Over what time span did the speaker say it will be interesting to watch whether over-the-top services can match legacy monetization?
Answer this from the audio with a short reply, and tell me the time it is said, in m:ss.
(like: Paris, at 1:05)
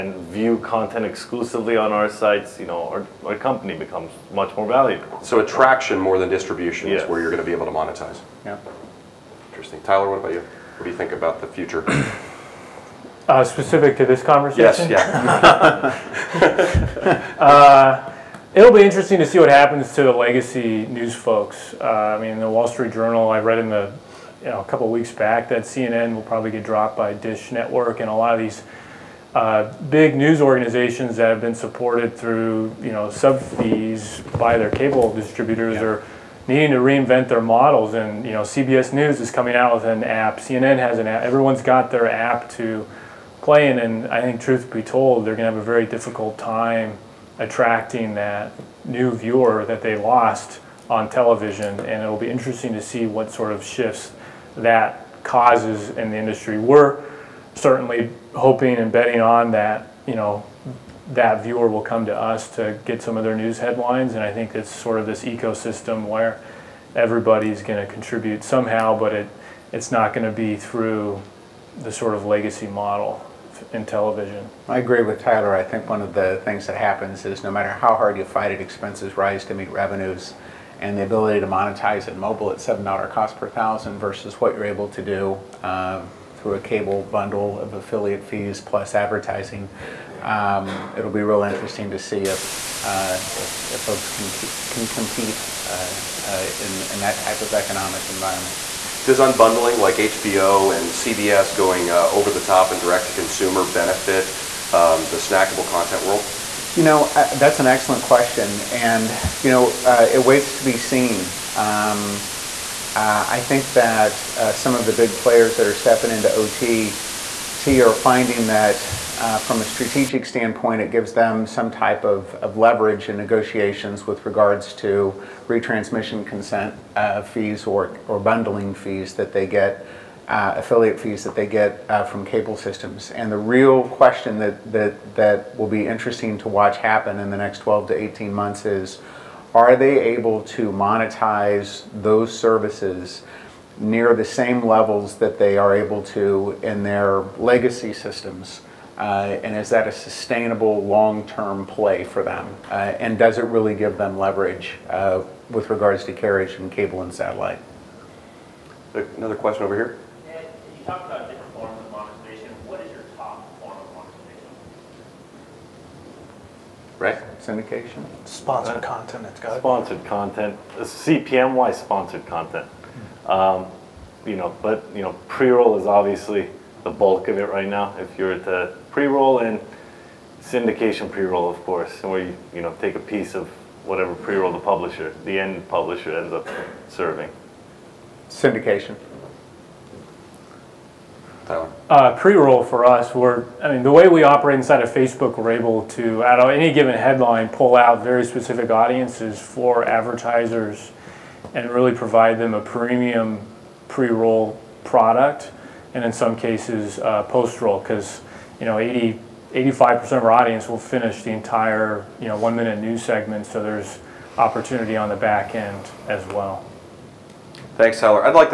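12 to 18 months, at 2:17.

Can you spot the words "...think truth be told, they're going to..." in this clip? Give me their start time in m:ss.
0:44.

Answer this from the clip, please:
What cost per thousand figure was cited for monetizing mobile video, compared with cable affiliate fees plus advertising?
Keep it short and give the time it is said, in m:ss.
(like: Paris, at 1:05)
$7, at 1:22.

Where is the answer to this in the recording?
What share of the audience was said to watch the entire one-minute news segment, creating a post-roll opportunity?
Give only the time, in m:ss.
3:28.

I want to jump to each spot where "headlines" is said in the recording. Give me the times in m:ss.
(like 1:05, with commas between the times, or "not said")
1:03, 3:16.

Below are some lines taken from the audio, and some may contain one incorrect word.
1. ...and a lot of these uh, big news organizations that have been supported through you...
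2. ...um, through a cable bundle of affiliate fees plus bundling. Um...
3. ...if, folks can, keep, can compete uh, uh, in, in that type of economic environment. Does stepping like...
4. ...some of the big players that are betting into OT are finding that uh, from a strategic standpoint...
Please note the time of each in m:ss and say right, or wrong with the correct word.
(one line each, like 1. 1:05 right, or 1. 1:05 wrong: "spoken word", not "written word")
1. 0:28 right
2. 1:25 wrong: "advertising", not "bundling"
3. 1:33 wrong: "unbundling", not "stepping"
4. 1:54 wrong: "stepping", not "betting".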